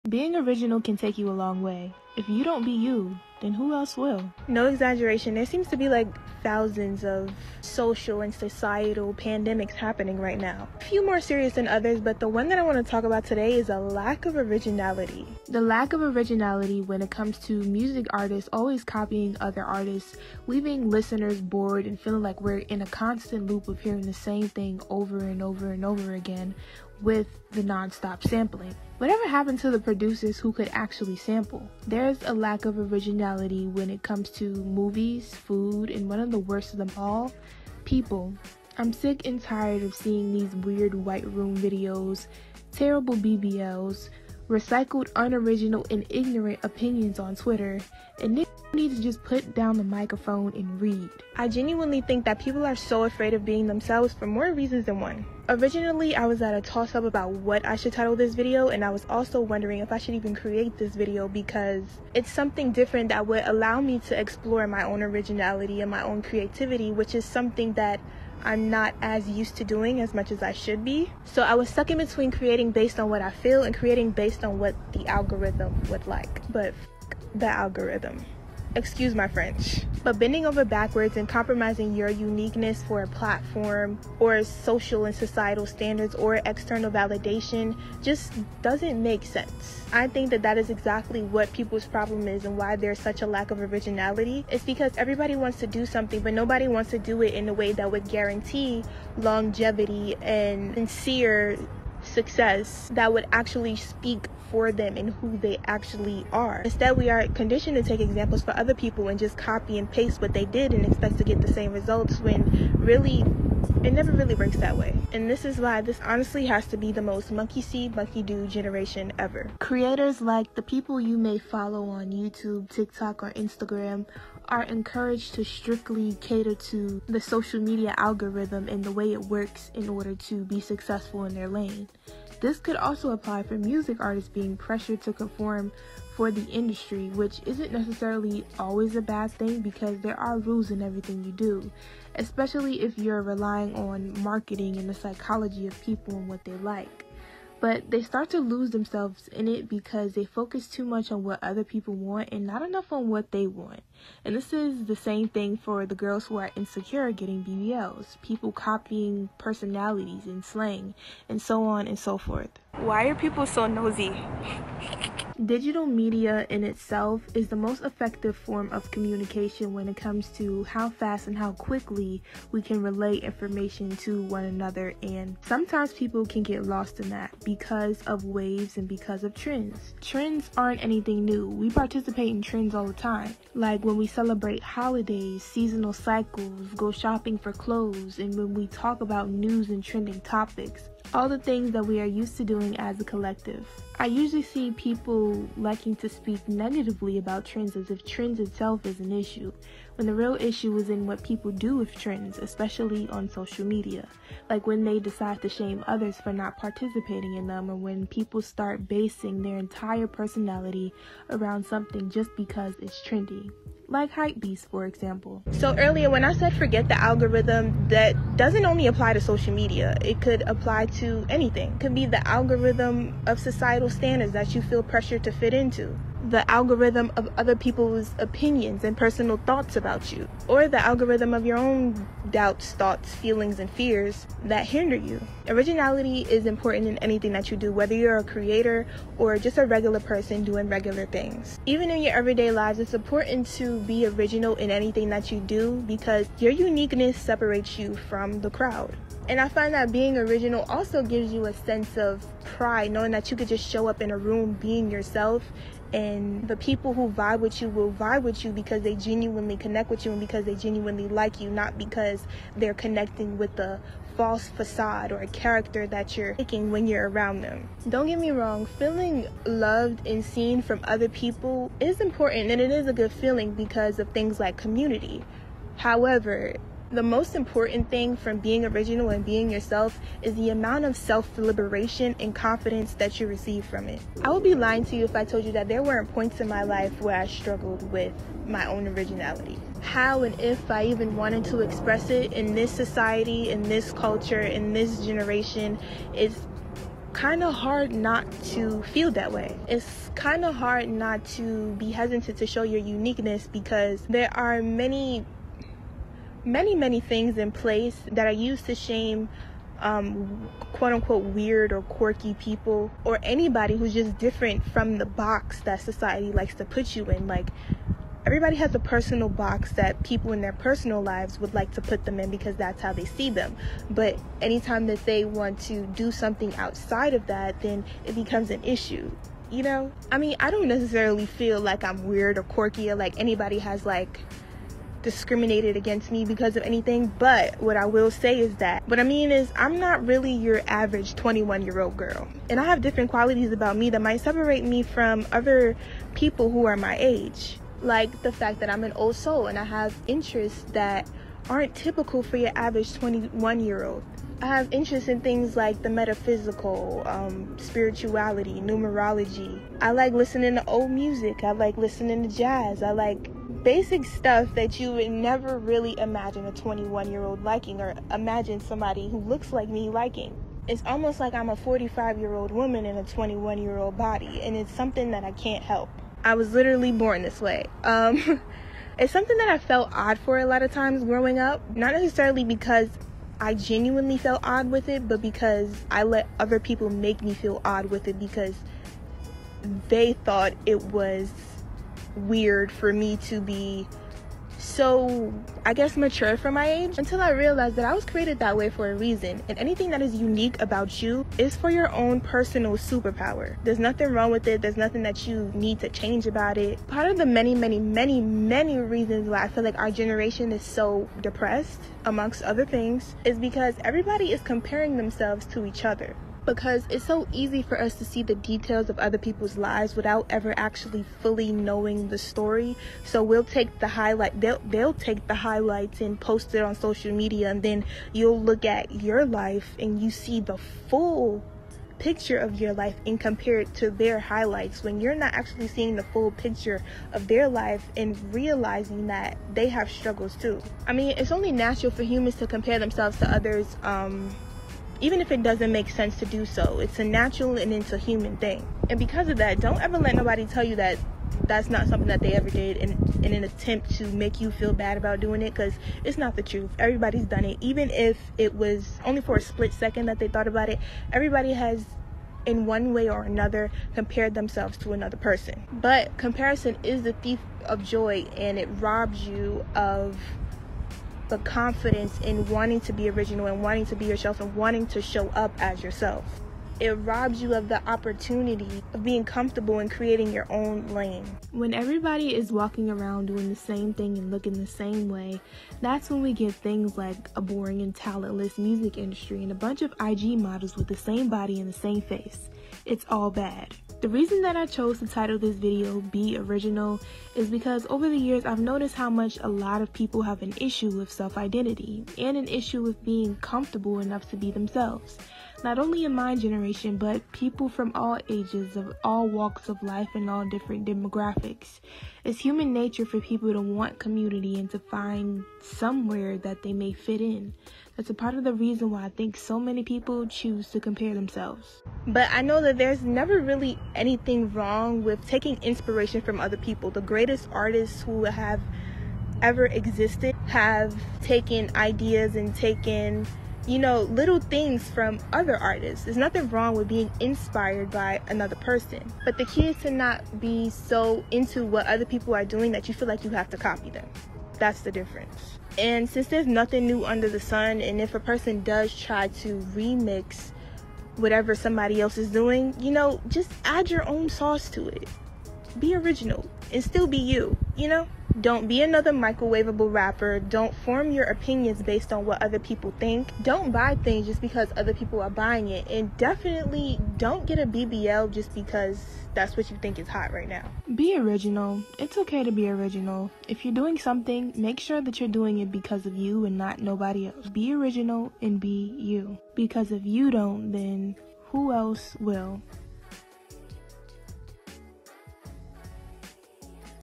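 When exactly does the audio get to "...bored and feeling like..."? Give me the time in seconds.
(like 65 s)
21 s.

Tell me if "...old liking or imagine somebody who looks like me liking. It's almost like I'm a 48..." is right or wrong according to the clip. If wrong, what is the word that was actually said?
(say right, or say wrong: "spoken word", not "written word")
wrong: "45", not "48".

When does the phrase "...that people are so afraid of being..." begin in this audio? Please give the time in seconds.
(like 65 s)
52 s.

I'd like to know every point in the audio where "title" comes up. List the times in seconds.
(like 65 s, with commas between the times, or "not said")
57 s, 495 s.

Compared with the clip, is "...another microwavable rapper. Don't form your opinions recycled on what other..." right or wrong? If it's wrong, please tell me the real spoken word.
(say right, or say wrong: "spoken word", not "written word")
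wrong: "based", not "recycled".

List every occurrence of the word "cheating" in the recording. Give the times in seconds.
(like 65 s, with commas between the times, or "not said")
not said.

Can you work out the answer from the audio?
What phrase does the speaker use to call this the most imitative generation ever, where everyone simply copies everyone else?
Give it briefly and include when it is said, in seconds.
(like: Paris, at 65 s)
monkey see, monkey do, at 117 s.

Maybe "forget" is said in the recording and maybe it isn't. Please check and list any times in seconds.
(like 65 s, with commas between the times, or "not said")
216 s.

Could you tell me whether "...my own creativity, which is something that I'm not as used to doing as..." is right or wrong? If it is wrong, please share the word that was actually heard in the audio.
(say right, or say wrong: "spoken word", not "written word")
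right.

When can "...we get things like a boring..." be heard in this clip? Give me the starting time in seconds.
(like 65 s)
486 s.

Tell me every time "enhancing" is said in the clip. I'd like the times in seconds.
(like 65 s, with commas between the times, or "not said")
not said.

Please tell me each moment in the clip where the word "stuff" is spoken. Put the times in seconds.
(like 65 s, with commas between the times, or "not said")
364 s.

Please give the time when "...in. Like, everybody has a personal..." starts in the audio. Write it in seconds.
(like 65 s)
317 s.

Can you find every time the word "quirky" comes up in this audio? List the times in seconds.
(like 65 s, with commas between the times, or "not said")
311 s, 332 s.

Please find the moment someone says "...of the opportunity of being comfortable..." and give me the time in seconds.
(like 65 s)
477 s.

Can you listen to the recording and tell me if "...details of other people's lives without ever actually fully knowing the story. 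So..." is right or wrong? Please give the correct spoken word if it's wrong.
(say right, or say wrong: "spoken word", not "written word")
right.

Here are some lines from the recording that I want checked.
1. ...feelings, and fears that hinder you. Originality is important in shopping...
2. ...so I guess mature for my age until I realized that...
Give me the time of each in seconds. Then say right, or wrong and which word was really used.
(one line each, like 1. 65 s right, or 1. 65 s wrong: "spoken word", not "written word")
1. 233 s wrong: "anything", not "shopping"
2. 394 s right.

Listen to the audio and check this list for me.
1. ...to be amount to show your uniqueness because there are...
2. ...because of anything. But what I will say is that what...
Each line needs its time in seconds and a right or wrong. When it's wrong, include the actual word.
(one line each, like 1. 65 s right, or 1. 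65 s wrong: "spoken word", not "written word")
1. 301 s wrong: "hesitant", not "amount"
2. 336 s right.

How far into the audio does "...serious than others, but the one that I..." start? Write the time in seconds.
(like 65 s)
11 s.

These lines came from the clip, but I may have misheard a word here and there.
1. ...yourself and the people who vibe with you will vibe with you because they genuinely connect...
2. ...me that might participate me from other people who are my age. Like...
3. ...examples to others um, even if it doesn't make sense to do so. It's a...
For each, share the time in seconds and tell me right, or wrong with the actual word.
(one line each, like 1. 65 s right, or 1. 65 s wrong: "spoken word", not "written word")
1. 254 s right
2. 343 s wrong: "separate", not "participate"
3. 442 s wrong: "themselves", not "examples".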